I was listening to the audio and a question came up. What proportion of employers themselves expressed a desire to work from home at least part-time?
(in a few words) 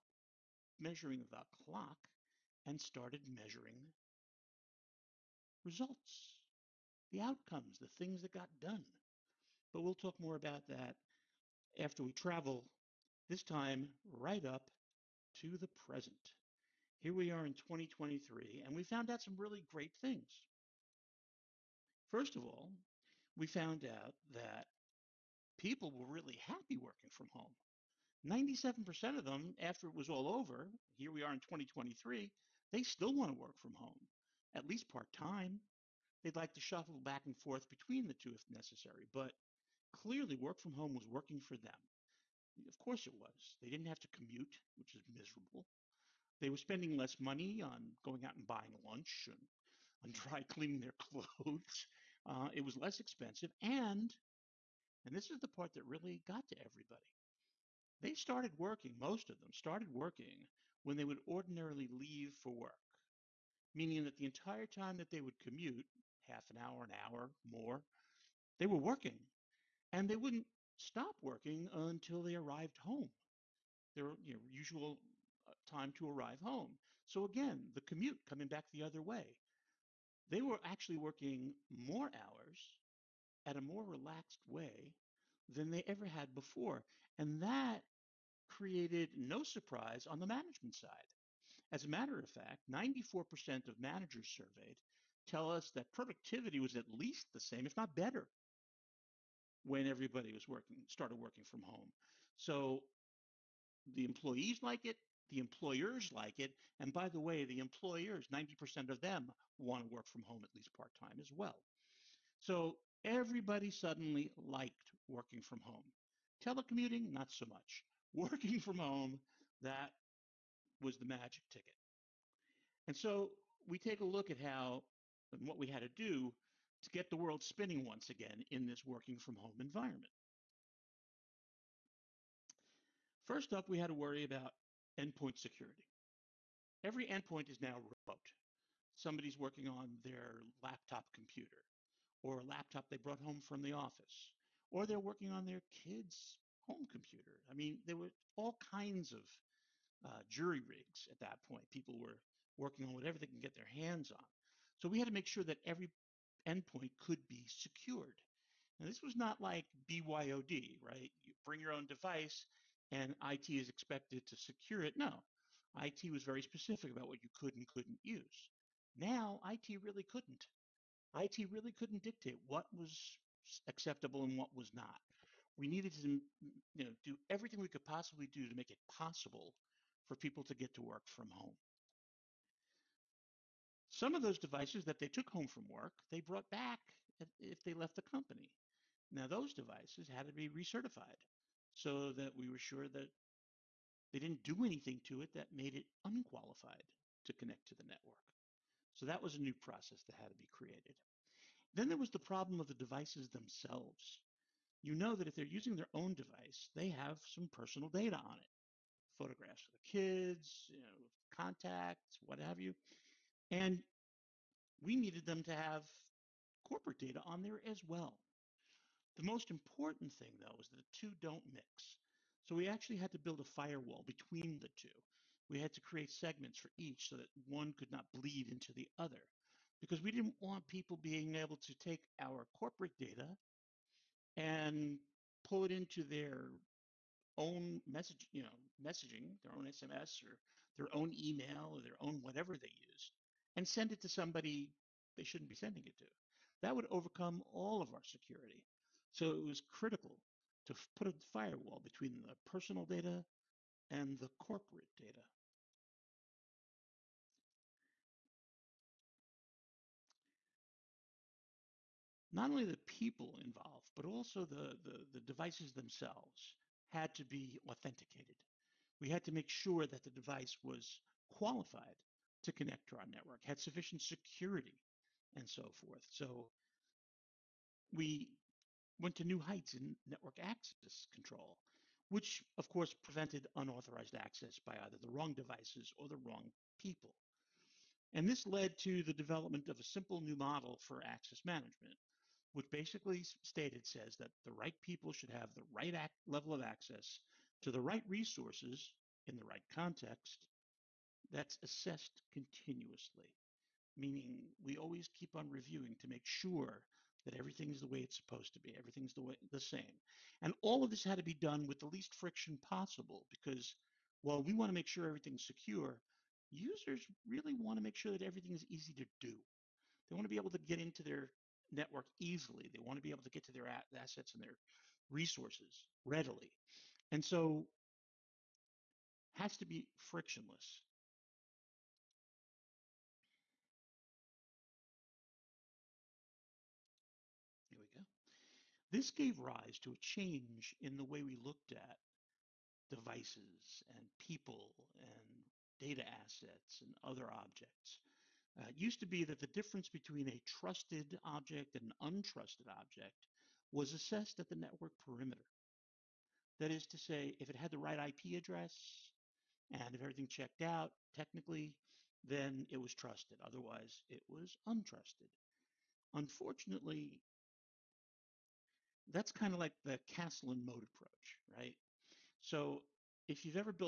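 90%.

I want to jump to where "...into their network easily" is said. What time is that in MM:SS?
05:20.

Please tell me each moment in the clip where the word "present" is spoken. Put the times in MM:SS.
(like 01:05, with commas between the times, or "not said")
00:15.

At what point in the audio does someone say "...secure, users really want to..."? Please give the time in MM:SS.
05:15.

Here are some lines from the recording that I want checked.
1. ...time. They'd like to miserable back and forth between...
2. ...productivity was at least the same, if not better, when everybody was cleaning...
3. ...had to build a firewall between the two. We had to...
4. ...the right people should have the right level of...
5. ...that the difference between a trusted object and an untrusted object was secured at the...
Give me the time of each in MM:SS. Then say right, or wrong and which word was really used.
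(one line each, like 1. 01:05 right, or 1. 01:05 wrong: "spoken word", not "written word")
1. 00:35 wrong: "shuffle", not "miserable"
2. 01:35 wrong: "working", not "cleaning"
3. 03:42 right
4. 04:54 right
5. 05:49 wrong: "assessed", not "secured".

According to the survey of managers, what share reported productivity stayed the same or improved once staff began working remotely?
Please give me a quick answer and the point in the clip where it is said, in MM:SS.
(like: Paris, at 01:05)
94%, at 01:32.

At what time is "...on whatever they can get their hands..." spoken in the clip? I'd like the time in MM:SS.
02:32.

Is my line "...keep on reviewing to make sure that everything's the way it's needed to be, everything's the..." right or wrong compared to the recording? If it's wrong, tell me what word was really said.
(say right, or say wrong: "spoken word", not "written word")
wrong: "supposed", not "needed".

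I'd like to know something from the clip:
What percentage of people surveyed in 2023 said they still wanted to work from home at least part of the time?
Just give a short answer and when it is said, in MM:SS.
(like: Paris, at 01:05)
97%, at 00:28.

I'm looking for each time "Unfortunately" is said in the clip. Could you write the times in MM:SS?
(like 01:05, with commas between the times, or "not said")
06:06.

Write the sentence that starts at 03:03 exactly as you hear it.
Some of those devices that they took home from work, they brought back if they left the company.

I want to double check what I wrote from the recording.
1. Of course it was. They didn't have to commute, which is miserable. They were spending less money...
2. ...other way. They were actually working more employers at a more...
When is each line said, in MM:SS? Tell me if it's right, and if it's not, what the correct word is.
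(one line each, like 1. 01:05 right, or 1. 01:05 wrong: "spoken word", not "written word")
1. 00:42 right
2. 01:18 wrong: "hours", not "employers".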